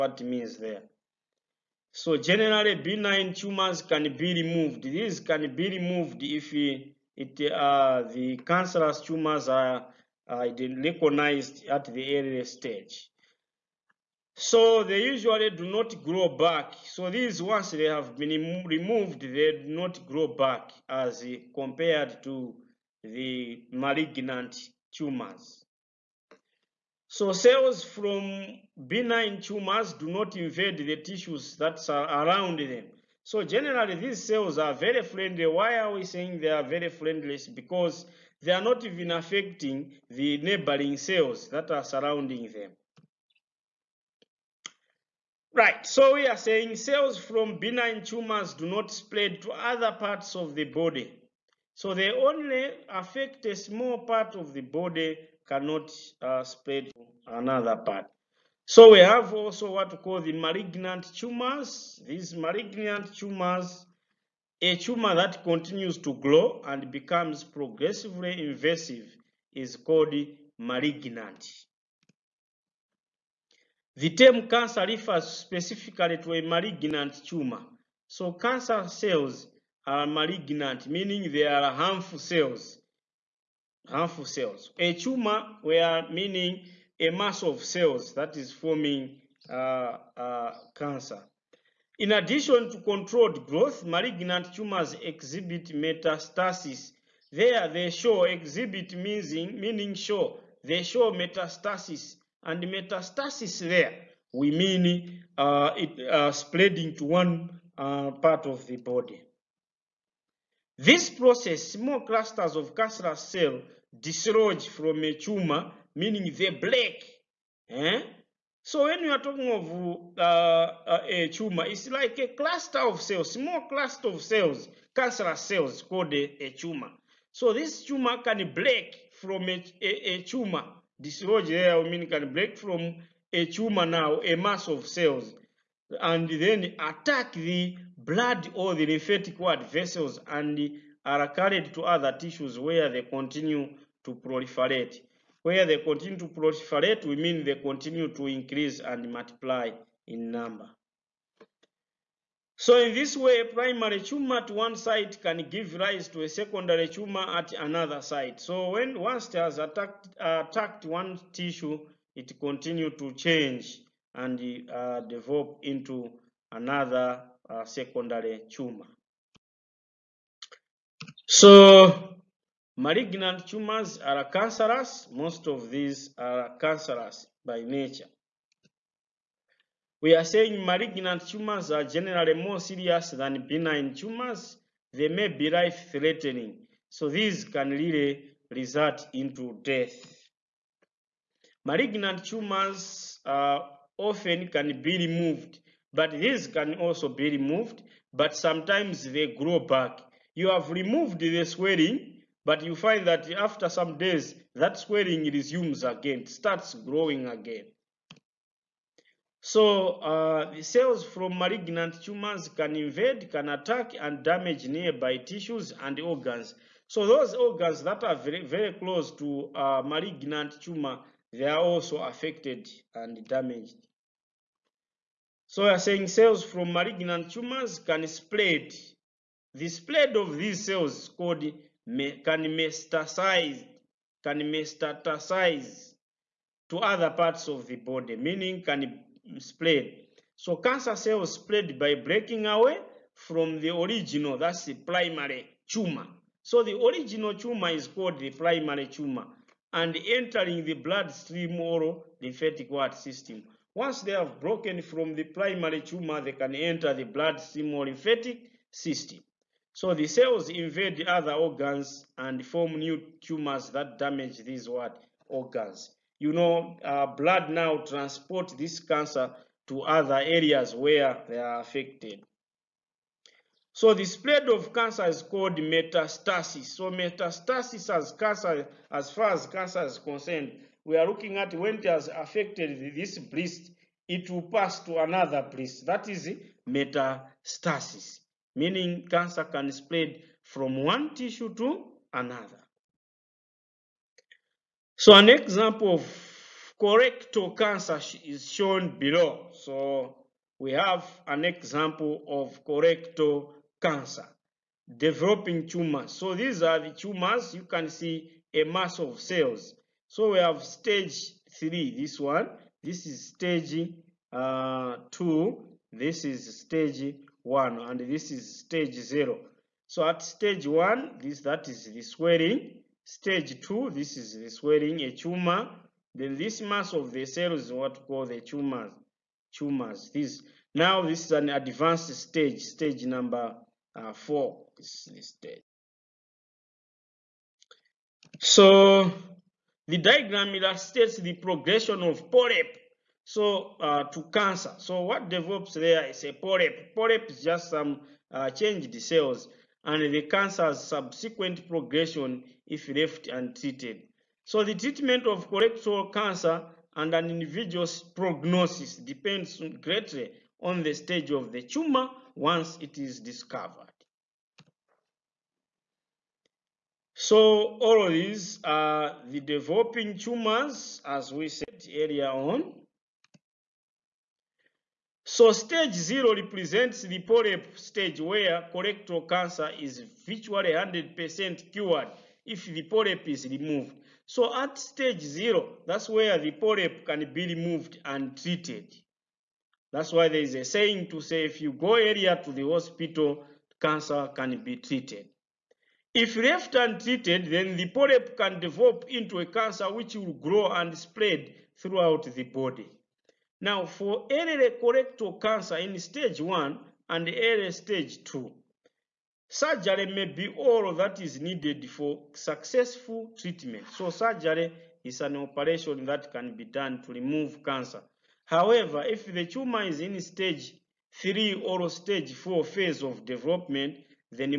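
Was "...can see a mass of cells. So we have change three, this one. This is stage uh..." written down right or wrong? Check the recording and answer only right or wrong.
wrong.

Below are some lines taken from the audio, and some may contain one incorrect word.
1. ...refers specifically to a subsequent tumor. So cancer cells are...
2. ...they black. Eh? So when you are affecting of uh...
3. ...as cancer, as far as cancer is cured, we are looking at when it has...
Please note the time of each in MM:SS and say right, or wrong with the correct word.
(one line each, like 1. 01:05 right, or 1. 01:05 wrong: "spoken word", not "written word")
1. 01:14 wrong: "malignant", not "subsequent"
2. 01:56 wrong: "talking", not "affecting"
3. 04:37 wrong: "concerned", not "cured".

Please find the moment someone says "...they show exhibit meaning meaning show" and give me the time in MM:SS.
01:37.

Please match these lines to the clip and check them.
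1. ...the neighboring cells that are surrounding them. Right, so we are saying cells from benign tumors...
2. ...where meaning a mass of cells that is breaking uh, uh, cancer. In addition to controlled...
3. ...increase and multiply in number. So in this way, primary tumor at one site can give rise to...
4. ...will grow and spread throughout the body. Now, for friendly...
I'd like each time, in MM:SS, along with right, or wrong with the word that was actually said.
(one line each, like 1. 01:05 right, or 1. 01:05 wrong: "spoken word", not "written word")
1. 00:40 right
2. 01:25 wrong: "forming", not "breaking"
3. 02:28 right
4. 06:40 wrong: "early", not "friendly".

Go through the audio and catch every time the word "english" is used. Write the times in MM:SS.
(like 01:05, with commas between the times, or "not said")
not said.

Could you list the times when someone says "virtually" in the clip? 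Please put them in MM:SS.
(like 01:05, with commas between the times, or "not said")
06:20.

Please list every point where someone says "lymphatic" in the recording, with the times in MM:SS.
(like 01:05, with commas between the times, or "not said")
02:18, 04:12, 04:17.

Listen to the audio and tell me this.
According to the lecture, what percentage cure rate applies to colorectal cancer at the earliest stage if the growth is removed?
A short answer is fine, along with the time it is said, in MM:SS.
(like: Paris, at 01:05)
100%, at 06:20.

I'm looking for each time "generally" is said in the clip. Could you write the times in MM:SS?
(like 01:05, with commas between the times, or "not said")
00:02, 00:33, 03:01.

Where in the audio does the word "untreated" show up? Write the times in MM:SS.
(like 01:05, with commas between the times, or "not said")
05:53, 06:36.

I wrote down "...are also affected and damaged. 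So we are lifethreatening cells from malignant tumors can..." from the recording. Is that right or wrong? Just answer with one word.
wrong.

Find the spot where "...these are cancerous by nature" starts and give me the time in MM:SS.
02:55.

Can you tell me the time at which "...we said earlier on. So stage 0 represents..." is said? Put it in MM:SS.
06:11.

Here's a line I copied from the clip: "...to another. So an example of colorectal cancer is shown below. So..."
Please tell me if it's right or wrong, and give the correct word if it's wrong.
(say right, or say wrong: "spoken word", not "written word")
right.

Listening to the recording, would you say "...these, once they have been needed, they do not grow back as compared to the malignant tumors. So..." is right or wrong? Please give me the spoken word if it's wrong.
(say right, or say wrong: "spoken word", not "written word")
wrong: "removed", not "needed".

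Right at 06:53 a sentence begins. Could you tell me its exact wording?
So surgery is an operation that can be done to remove cancer.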